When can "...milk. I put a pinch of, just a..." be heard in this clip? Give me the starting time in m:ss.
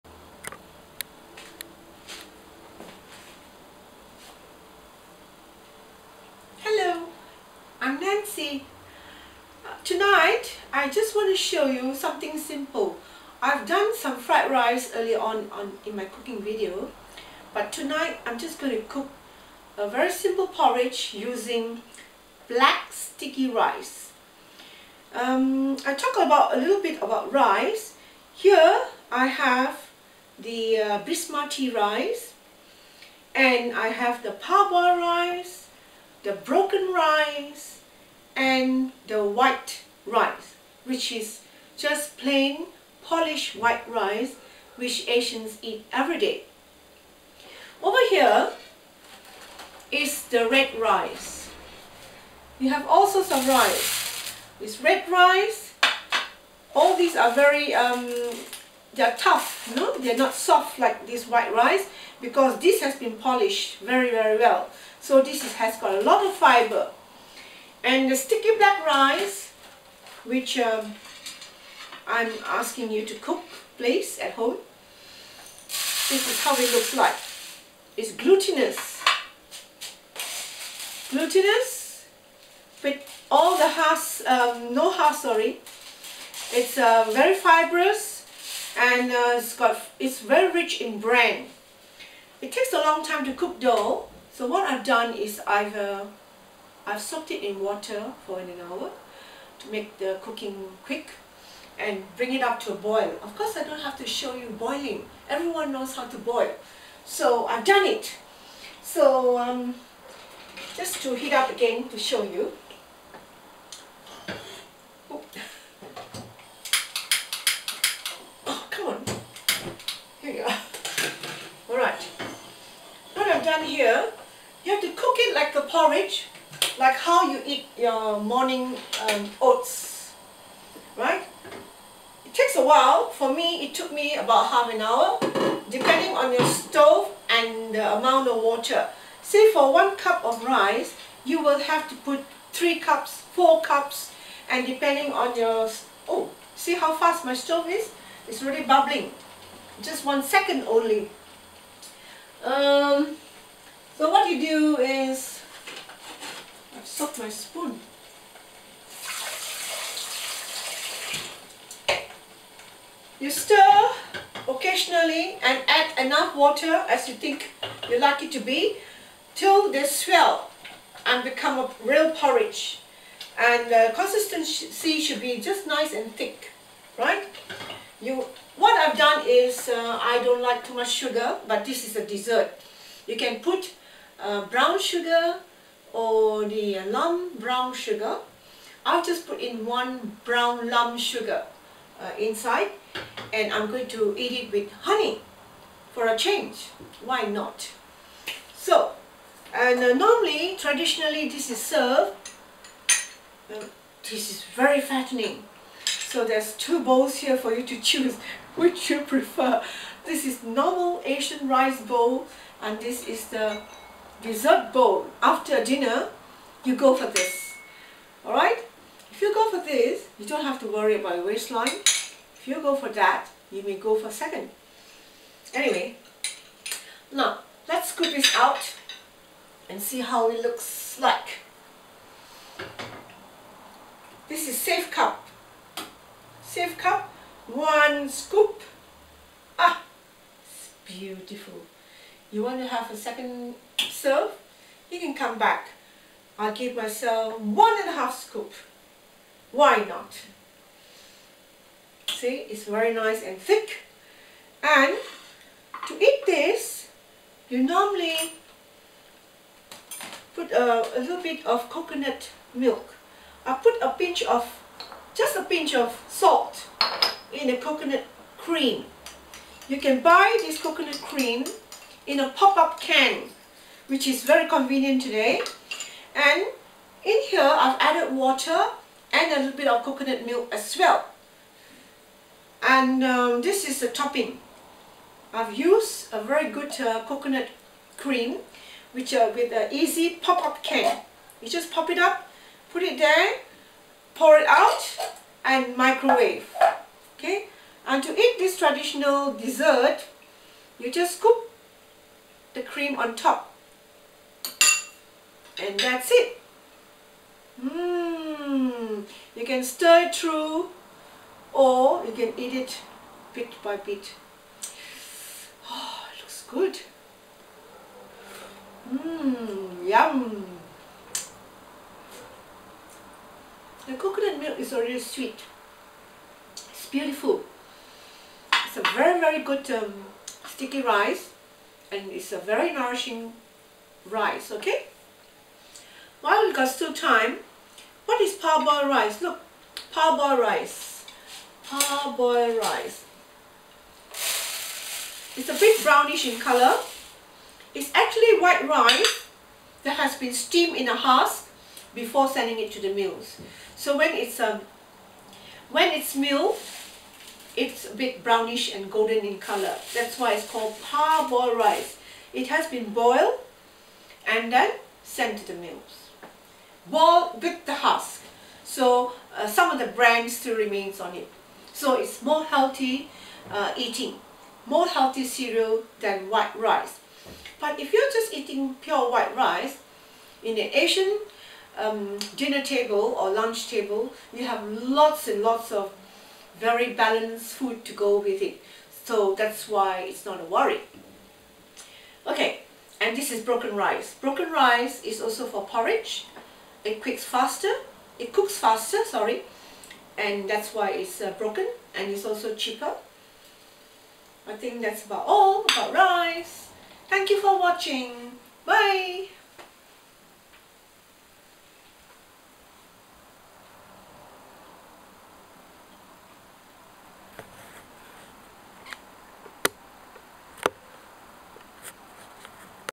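4:22.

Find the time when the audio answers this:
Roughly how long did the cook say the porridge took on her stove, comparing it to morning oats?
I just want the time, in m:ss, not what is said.
2:14.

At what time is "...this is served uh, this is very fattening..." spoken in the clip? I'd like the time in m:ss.
3:21.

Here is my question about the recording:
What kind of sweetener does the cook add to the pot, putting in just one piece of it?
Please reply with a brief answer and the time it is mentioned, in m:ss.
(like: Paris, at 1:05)
brown lump sugar, at 3:10.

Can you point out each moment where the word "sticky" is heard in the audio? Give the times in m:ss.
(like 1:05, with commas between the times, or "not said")
0:22, 1:08, 5:30.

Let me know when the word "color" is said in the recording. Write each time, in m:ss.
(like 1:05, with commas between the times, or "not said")
5:46, 5:59.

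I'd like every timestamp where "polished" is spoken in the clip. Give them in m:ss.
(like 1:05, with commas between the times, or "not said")
0:43, 1:03.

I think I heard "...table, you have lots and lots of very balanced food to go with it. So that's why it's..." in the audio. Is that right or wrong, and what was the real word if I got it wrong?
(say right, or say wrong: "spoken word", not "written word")
right.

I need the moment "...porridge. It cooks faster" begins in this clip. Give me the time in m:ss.
6:35.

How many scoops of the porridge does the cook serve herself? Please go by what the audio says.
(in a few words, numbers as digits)
one and a half.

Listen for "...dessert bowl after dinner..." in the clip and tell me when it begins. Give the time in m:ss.
3:34.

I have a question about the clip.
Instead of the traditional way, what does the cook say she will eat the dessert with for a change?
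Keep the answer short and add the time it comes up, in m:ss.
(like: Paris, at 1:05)
honey, at 3:14.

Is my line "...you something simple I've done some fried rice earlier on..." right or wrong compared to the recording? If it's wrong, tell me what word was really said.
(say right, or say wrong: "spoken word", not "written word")
right.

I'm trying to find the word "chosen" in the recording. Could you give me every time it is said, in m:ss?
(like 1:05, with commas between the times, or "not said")
not said.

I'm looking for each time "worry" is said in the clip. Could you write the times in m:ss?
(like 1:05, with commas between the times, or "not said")
3:40, 6:30.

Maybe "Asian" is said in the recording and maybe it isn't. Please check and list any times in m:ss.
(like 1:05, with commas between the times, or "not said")
0:45, 3:31, 6:20.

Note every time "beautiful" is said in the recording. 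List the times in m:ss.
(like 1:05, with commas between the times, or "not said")
4:00, 5:26.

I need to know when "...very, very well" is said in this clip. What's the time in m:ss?
1:03.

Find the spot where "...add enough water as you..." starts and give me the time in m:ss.
2:45.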